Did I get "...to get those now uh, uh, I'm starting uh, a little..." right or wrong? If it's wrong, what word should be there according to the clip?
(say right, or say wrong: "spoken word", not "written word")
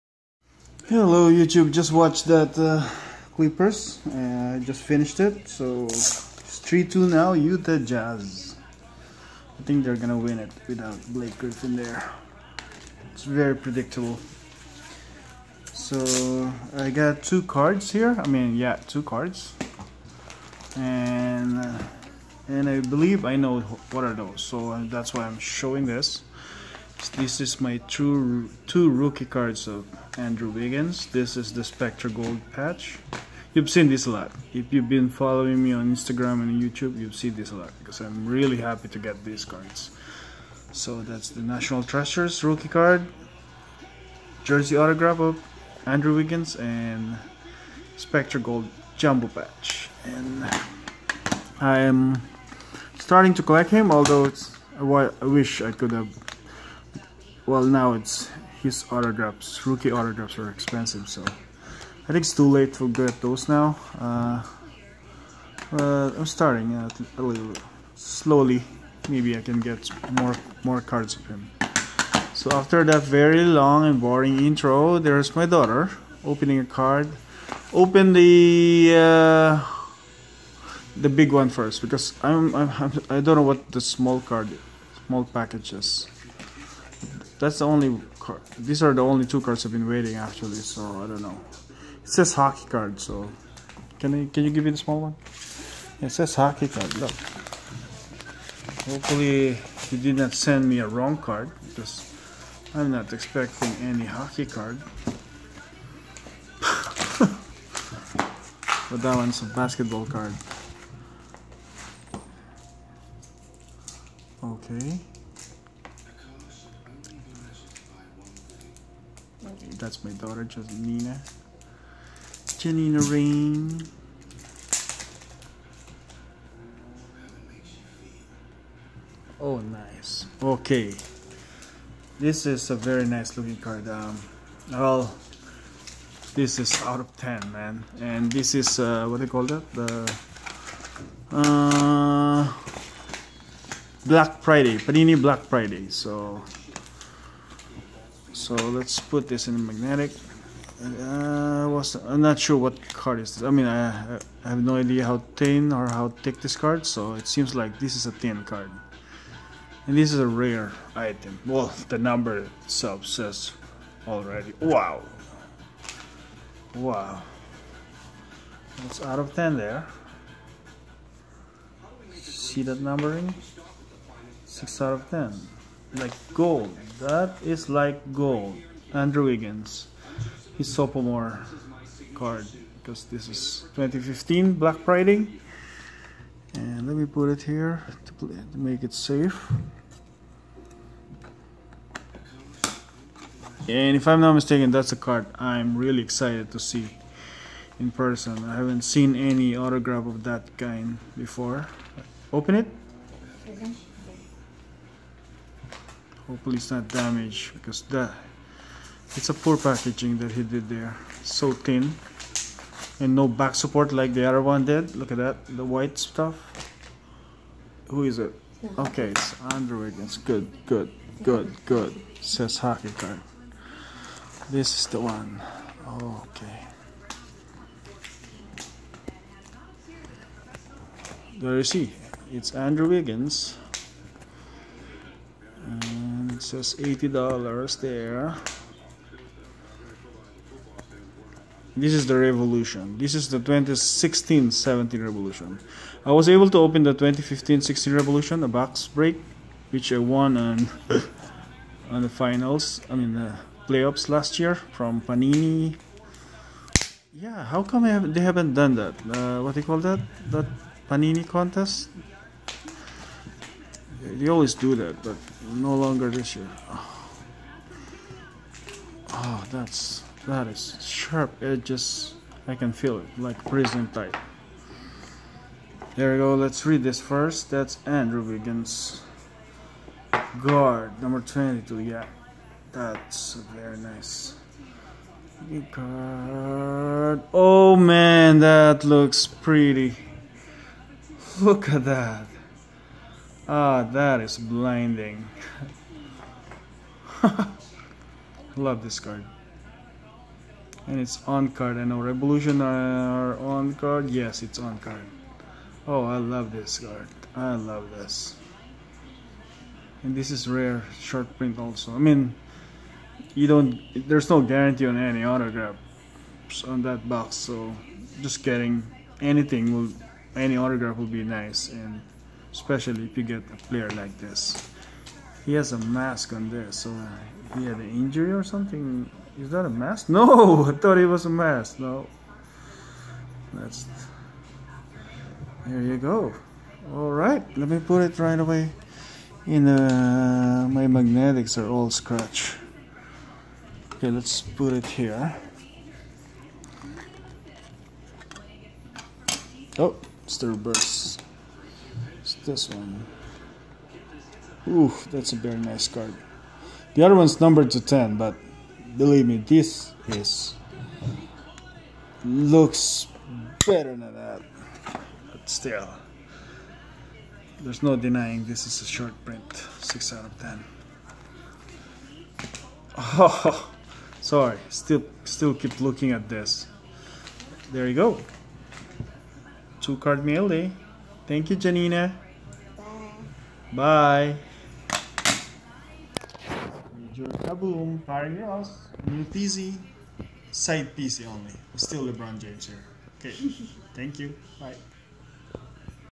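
right.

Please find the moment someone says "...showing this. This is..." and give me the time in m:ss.
0:25.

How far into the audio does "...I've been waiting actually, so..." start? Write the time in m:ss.
1:29.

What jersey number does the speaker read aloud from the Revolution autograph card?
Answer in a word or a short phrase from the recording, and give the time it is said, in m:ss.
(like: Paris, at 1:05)
22, at 4:41.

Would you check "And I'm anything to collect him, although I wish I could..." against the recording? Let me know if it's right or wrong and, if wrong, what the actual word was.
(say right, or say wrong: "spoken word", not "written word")
wrong: "starting", not "anything".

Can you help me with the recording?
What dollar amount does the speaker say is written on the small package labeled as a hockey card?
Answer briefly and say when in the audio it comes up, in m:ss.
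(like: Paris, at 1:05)
$80, at 3:56.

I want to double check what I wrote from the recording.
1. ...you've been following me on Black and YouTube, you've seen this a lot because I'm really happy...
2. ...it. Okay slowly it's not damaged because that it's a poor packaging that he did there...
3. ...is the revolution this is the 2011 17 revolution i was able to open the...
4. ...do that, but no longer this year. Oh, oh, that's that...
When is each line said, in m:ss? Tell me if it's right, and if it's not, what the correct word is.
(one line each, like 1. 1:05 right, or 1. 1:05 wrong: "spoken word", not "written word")
1. 0:34 wrong: "Instagram", not "Black"
2. 3:22 wrong: "hopefully", not "slowly"
3. 4:01 wrong: "2016", not "2011"
4. 4:24 right.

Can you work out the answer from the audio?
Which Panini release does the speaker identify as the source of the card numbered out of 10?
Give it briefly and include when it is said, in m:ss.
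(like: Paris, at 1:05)
Panini Black Friday, at 2:24.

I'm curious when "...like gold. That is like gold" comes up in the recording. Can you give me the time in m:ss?
2:55.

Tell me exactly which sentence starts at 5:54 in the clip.
Ooh, that's a very nice card.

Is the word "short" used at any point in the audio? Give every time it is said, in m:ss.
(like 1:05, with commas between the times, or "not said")
5:10, 6:08.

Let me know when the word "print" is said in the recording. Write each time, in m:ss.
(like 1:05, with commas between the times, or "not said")
5:11, 6:09.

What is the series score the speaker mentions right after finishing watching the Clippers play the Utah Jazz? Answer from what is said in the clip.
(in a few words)
3-2.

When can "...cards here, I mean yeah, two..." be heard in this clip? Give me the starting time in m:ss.
0:17.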